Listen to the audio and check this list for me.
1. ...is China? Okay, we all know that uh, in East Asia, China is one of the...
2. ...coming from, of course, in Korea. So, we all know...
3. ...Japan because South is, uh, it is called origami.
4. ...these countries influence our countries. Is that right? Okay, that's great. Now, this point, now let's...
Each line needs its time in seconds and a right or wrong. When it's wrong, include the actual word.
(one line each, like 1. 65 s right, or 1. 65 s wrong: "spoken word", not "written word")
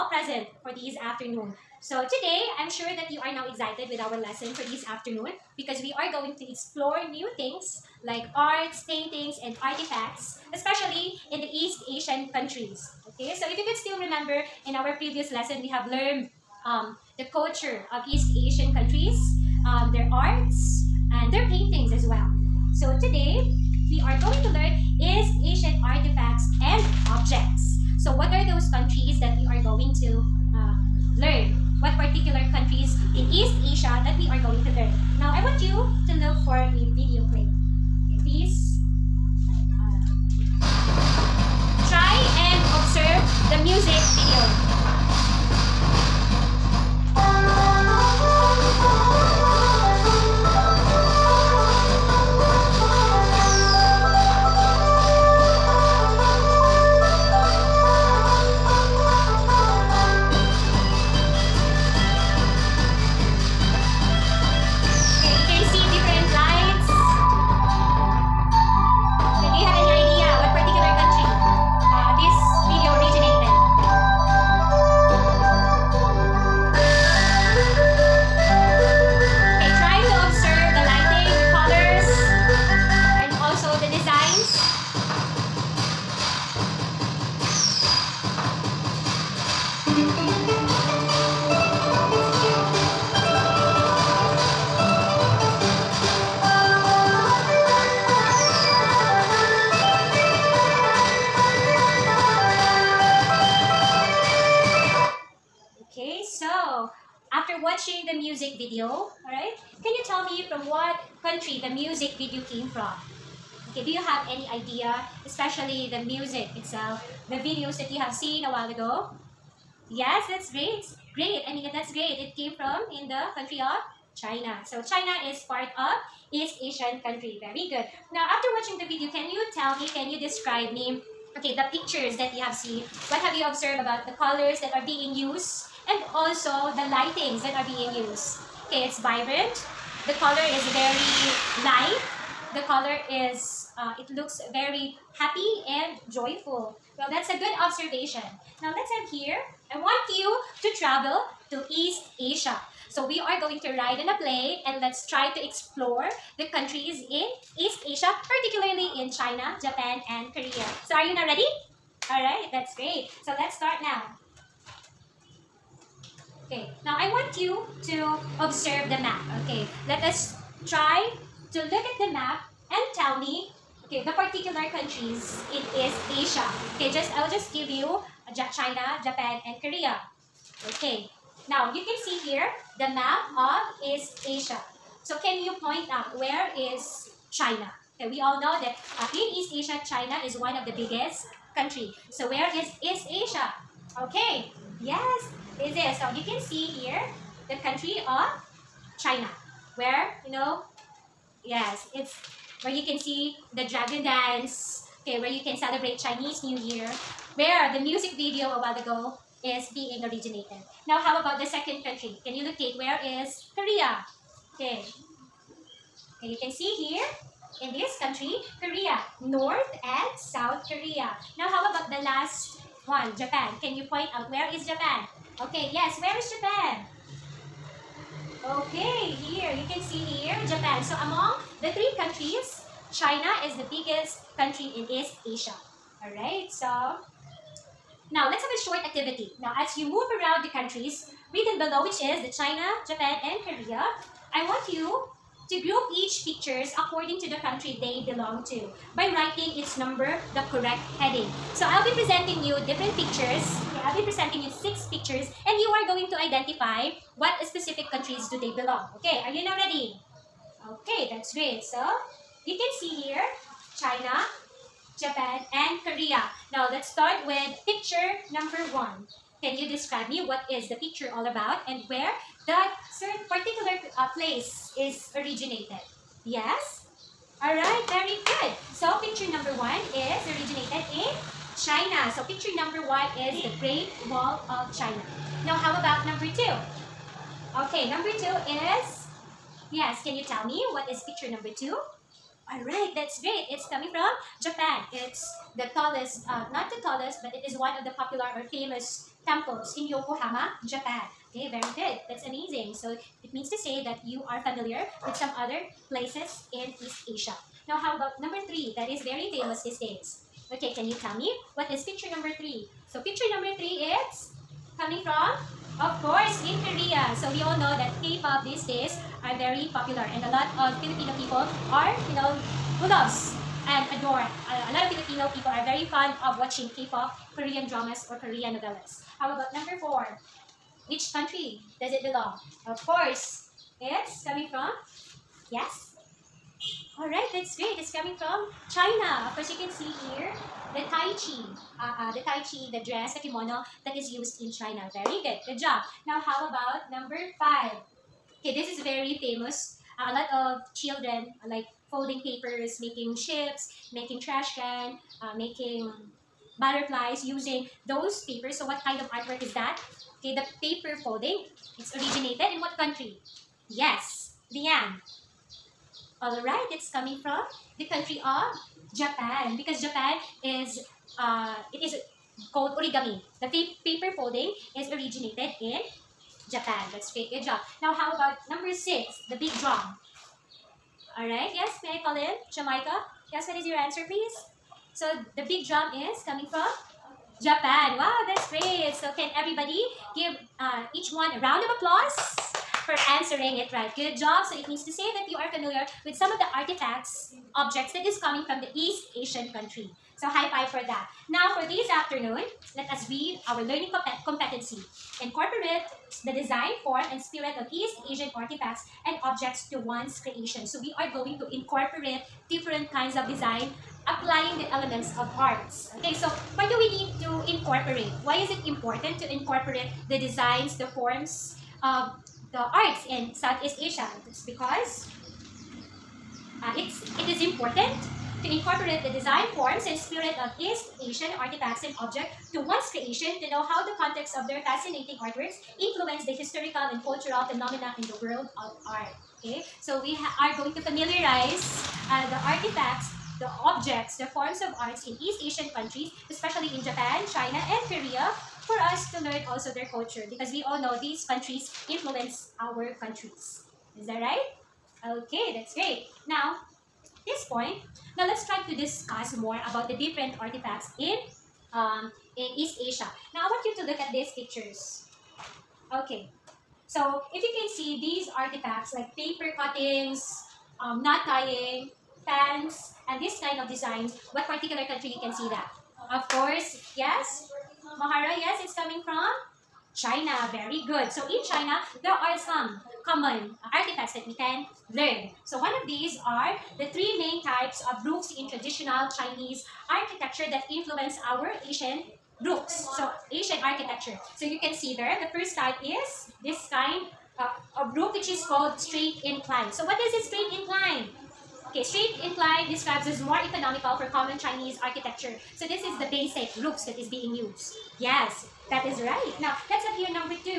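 1. 186 s right
2. 314 s right
3. 368 s wrong: "Japan", not "South"
4. 451 s right.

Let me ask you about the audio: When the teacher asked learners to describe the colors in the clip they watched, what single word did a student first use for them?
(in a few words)
vibrant.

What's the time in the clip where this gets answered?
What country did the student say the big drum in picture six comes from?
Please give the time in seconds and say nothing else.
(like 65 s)
382 s.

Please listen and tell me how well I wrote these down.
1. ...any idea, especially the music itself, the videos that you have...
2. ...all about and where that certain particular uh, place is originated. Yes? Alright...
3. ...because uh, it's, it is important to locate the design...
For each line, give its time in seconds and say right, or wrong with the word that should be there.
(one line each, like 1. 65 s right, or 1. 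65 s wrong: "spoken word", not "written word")
1. 114 s right
2. 271 s right
3. 424 s wrong: "incorporate", not "locate".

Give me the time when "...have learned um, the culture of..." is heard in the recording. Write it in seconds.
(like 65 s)
15 s.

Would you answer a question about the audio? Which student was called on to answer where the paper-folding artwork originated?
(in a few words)
Leanne.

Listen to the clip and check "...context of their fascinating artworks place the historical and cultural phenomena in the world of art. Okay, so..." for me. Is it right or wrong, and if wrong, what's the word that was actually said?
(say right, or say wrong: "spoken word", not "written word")
wrong: "influence", not "place".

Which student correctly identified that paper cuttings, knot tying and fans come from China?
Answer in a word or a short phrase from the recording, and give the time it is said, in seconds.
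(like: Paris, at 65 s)
Mahara, at 477 s.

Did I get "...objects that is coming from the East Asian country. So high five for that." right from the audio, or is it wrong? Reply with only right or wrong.
right.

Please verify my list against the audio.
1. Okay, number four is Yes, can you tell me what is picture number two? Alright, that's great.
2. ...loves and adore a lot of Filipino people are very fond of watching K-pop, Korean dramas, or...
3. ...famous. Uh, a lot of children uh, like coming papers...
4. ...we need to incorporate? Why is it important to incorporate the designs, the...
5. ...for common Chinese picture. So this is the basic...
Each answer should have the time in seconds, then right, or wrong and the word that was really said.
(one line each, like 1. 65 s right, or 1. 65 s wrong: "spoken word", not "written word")
1. 287 s wrong: "two", not "four"
2. 322 s right
3. 349 s wrong: "folding", not "coming"
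4. 416 s right
5. 503 s wrong: "architecture", not "picture".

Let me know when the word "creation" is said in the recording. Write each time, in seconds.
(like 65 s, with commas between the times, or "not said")
410 s, 432 s.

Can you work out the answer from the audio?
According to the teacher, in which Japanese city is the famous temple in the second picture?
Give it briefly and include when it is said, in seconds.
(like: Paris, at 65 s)
Yokohama, at 299 s.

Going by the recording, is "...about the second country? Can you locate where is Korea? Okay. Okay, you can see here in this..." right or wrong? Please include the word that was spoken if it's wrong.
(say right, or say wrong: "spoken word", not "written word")
right.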